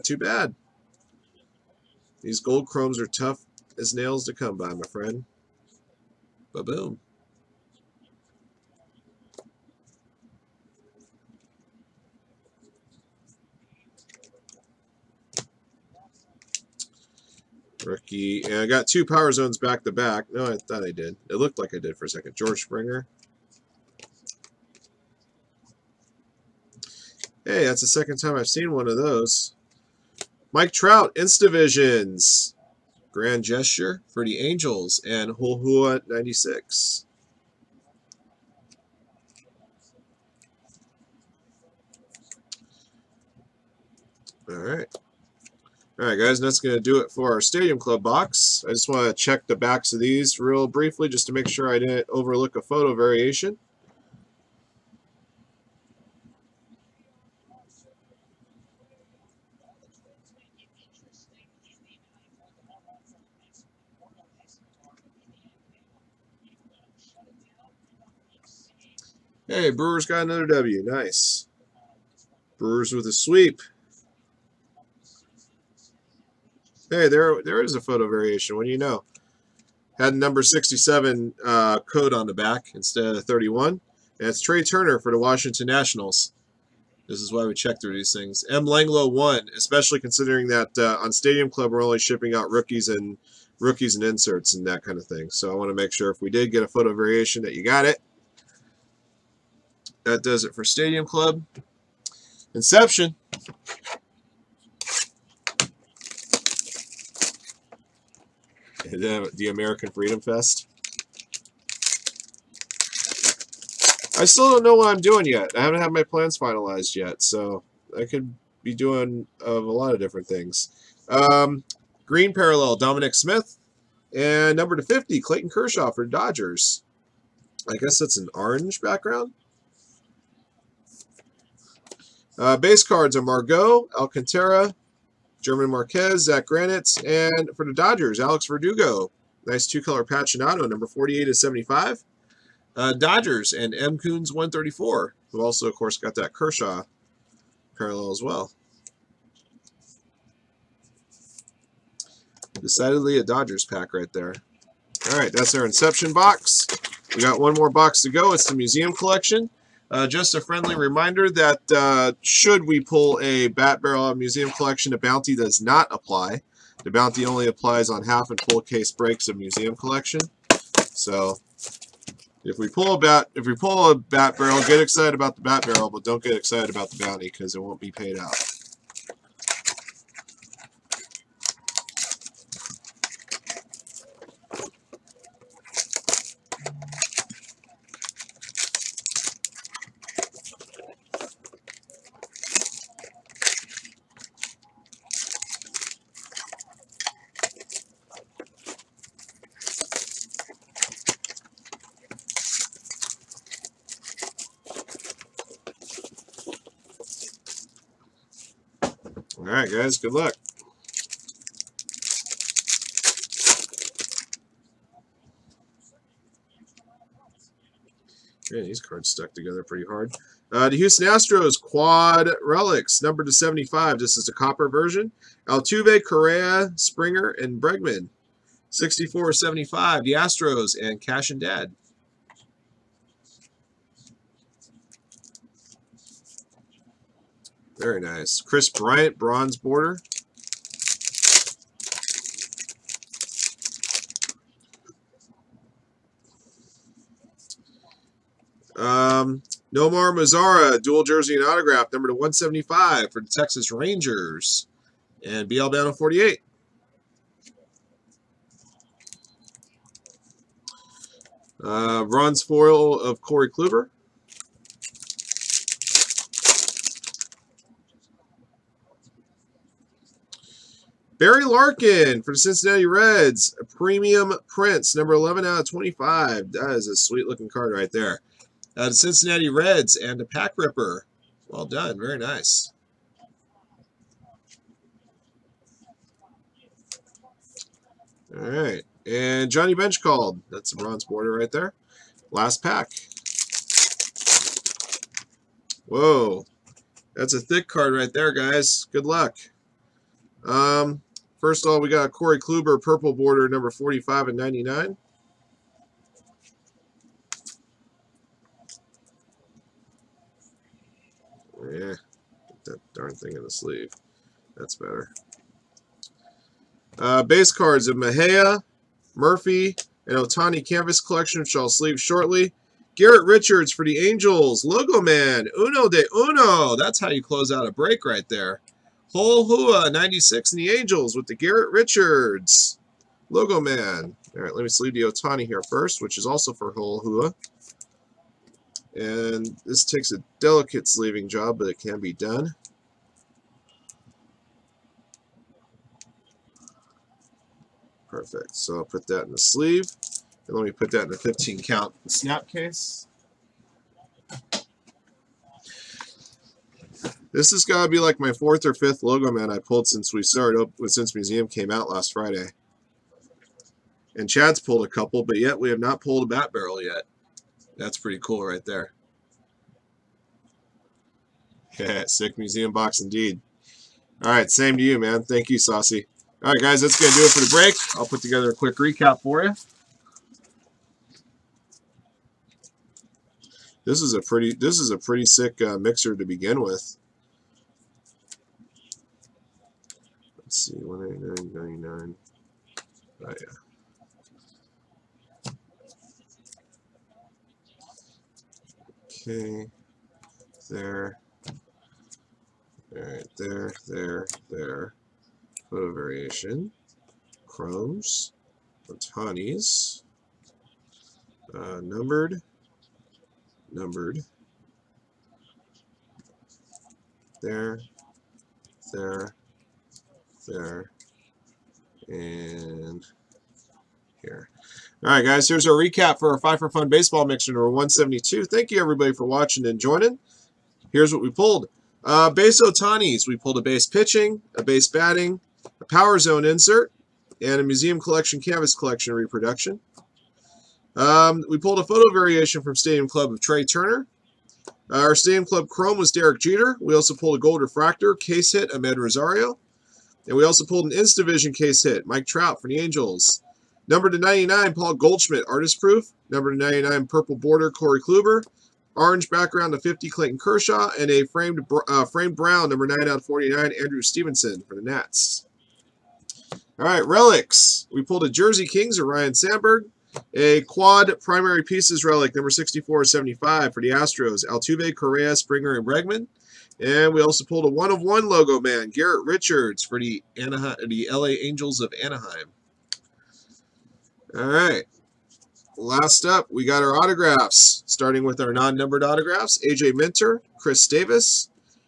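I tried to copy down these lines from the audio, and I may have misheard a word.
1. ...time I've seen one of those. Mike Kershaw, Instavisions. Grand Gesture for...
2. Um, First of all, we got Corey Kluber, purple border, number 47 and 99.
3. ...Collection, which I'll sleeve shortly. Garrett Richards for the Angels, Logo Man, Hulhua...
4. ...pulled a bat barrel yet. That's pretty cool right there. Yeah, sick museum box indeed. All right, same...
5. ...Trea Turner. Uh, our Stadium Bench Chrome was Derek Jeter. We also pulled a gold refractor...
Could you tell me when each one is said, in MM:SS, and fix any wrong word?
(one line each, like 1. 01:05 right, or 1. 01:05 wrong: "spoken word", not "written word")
1. 00:28 wrong: "Trout", not "Kershaw"
2. 05:00 wrong: "45", not "47"
3. 05:21 wrong: "Uno", not "Hulhua"
4. 06:05 right
5. 07:23 wrong: "Club", not "Bench".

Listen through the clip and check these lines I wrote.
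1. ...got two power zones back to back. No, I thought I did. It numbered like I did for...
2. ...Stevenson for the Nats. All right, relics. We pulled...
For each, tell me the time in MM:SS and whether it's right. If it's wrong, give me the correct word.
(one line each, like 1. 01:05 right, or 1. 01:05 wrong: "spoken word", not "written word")
1. 00:18 wrong: "looked", not "numbered"
2. 07:44 right.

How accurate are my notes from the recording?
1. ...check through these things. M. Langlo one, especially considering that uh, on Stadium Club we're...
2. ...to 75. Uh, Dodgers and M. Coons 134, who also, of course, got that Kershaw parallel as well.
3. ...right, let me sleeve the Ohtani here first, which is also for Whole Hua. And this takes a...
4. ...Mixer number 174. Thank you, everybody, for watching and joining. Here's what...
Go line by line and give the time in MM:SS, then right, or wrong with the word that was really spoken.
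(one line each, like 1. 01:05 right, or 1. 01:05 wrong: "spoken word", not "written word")
1. 01:27 right
2. 02:21 right
3. 05:34 right
4. 07:07 wrong: "172", not "174".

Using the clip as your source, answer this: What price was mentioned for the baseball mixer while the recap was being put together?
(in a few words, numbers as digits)
$189.99.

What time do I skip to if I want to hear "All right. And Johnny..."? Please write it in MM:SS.
04:48.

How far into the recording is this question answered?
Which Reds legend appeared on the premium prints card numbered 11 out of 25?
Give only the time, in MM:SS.
04:31.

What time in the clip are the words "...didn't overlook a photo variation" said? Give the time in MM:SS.
00:51.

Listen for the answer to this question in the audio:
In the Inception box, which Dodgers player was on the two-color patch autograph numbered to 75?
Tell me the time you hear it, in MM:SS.
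02:18.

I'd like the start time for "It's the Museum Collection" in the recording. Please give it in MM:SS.
02:38.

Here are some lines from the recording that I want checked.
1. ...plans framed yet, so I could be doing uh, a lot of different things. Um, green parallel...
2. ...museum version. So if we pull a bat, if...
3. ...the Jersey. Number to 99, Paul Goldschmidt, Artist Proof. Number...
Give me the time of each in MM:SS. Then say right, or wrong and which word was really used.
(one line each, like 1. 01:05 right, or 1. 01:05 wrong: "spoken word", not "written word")
1. 01:56 wrong: "finalized", not "framed"
2. 02:49 wrong: "collection", not "version"
3. 07:32 wrong: "Angels", not "Jersey".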